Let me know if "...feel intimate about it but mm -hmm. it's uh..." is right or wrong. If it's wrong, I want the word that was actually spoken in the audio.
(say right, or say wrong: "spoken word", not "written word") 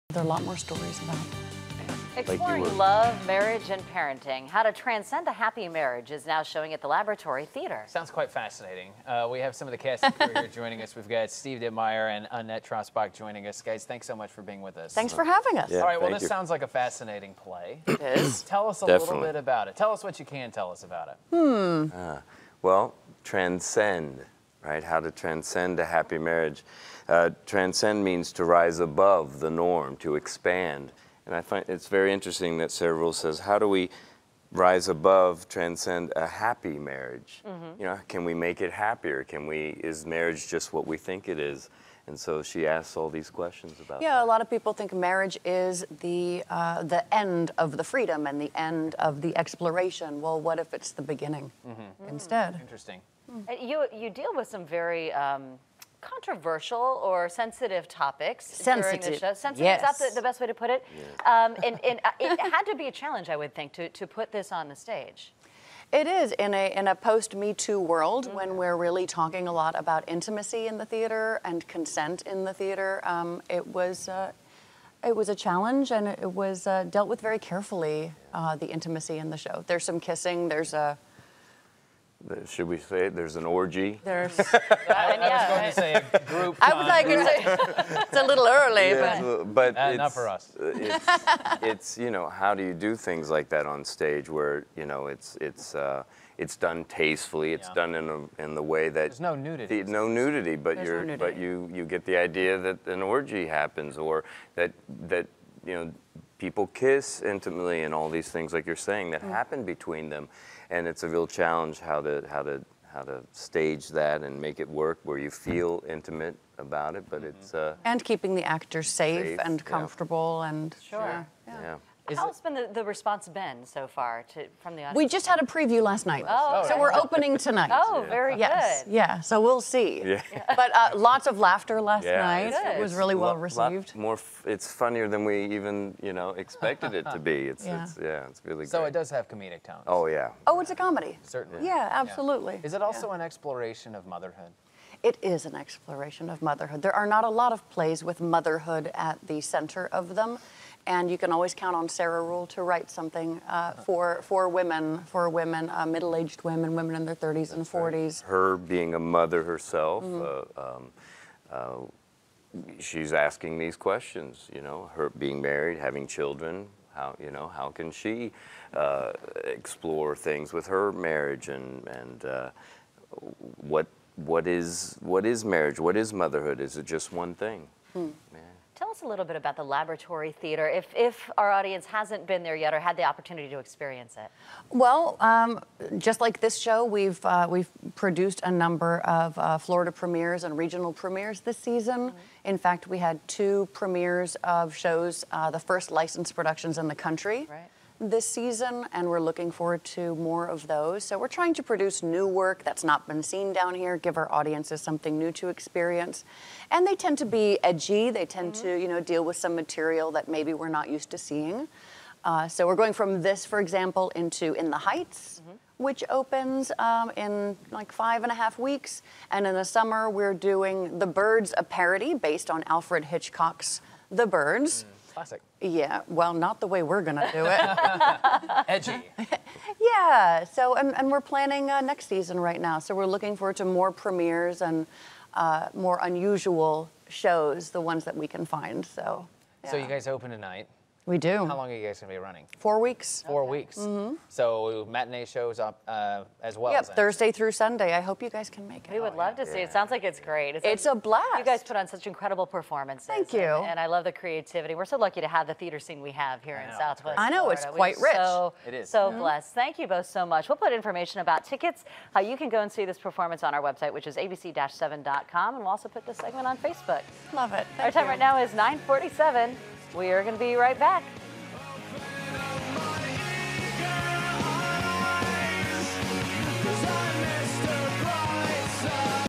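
right.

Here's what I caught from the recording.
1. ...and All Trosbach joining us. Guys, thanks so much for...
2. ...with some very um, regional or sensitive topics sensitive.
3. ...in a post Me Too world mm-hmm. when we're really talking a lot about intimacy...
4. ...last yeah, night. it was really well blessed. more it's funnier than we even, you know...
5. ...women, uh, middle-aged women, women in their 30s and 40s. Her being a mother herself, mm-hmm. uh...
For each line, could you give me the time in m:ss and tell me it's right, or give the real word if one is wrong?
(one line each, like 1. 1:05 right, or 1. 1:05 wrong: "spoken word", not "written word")
1. 0:12 wrong: "Annette", not "All"
2. 0:54 wrong: "controversial", not "regional"
3. 1:06 right
4. 2:11 wrong: "received", not "blessed"
5. 2:35 right.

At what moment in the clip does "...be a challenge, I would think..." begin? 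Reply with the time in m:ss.
1:02.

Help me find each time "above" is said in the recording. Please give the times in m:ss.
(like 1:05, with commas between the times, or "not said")
0:28, 0:34.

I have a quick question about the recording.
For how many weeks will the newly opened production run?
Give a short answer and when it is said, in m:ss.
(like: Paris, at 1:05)
4 weeks, at 4:02.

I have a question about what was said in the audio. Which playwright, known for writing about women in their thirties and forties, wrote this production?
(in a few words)
Sarah Ruhl.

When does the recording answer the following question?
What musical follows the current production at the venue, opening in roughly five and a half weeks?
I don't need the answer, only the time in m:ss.
3:34.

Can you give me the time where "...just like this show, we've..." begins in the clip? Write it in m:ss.
3:05.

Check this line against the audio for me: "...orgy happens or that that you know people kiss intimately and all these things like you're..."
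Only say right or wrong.
right.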